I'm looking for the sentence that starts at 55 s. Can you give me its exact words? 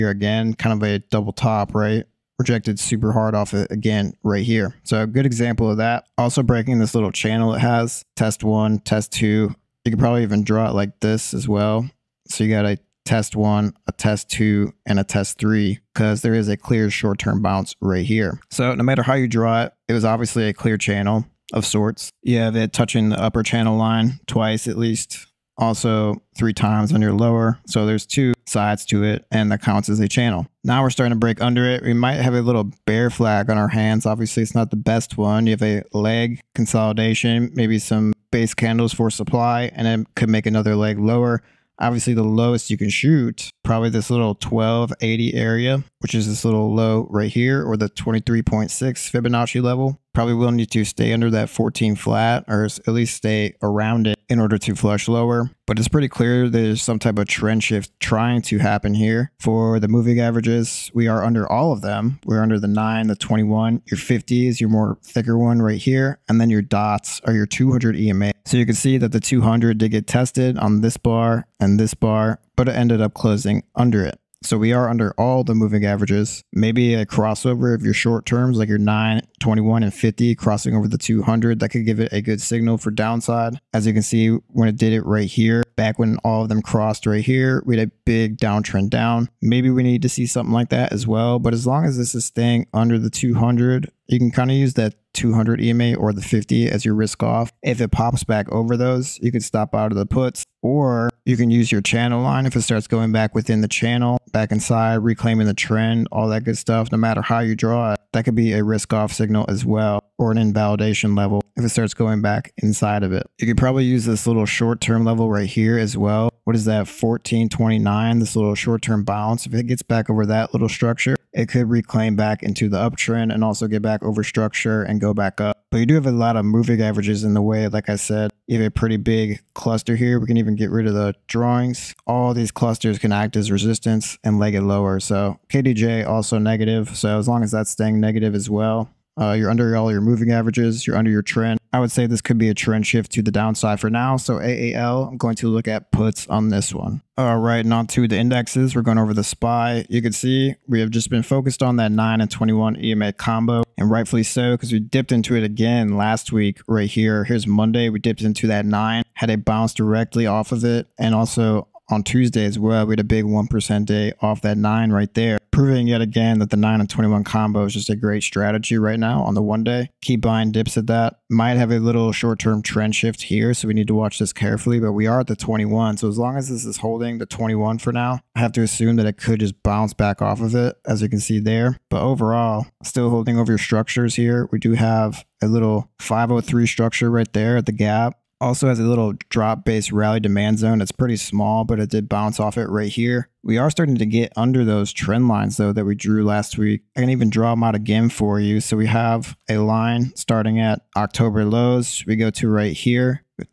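But it's pretty clear there's some type of trend shift trying to happen here.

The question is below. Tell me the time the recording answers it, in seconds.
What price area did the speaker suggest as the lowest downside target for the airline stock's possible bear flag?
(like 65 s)
44 s.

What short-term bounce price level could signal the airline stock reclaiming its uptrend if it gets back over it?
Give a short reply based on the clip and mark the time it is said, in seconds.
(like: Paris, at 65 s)
1429, at 116 s.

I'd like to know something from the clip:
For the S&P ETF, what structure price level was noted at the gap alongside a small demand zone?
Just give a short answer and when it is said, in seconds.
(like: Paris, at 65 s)
503, at 185 s.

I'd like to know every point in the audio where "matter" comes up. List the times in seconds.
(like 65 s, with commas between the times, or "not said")
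18 s, 106 s.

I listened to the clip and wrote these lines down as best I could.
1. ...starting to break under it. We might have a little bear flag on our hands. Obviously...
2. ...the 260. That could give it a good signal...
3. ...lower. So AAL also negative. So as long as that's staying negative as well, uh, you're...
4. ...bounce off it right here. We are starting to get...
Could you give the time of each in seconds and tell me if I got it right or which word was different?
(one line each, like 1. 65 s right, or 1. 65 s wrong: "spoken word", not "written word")
1. 30 s right
2. 80 s wrong: "200", not "260"
3. 134 s wrong: "KDJ", not "AAL"
4. 192 s right.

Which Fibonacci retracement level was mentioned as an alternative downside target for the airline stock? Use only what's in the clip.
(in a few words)
23.6.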